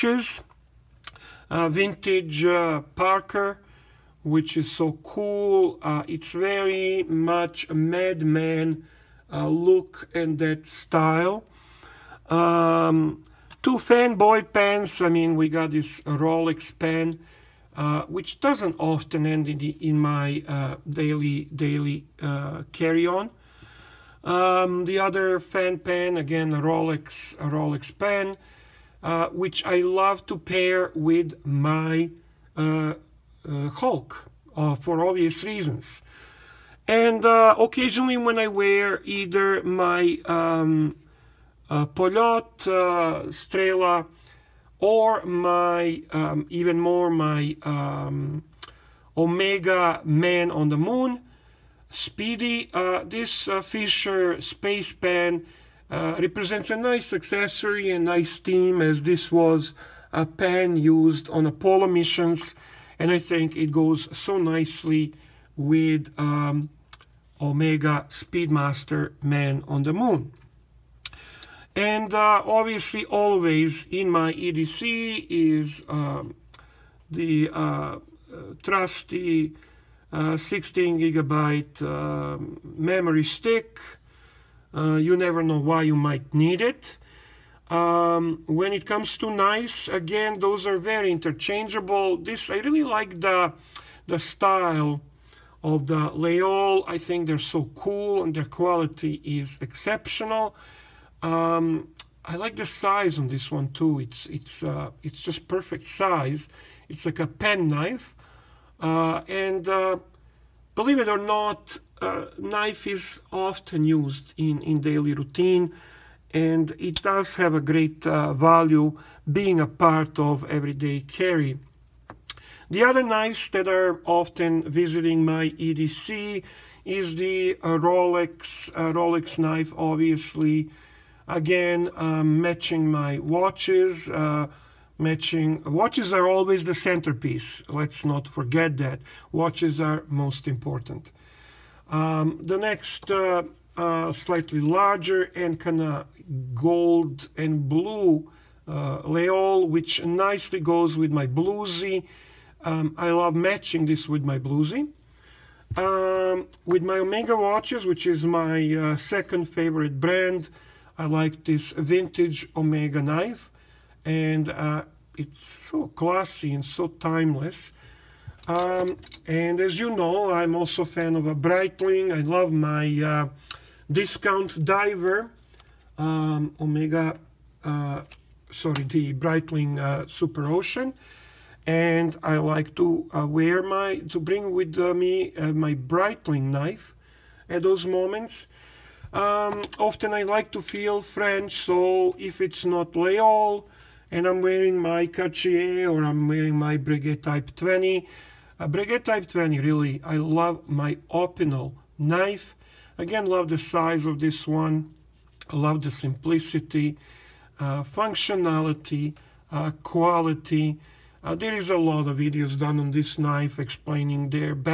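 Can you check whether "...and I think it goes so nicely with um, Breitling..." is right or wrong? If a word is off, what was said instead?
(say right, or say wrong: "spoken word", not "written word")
wrong: "Omega", not "Breitling".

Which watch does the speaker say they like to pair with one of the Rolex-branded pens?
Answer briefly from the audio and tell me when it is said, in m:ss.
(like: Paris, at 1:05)
Hulk, at 0:33.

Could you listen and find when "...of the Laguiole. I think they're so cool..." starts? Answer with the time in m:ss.
1:35.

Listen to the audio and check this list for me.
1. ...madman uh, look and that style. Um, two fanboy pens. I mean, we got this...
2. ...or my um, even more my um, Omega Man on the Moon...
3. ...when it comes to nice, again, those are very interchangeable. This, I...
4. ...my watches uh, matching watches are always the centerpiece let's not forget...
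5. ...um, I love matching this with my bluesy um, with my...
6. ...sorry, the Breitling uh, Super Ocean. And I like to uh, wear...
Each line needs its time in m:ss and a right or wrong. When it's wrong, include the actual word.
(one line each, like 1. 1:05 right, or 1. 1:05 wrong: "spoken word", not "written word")
1. 0:07 right
2. 0:44 right
3. 1:28 right
4. 2:12 right
5. 2:32 right
6. 2:58 right.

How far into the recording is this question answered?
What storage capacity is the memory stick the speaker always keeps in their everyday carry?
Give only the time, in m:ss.
1:20.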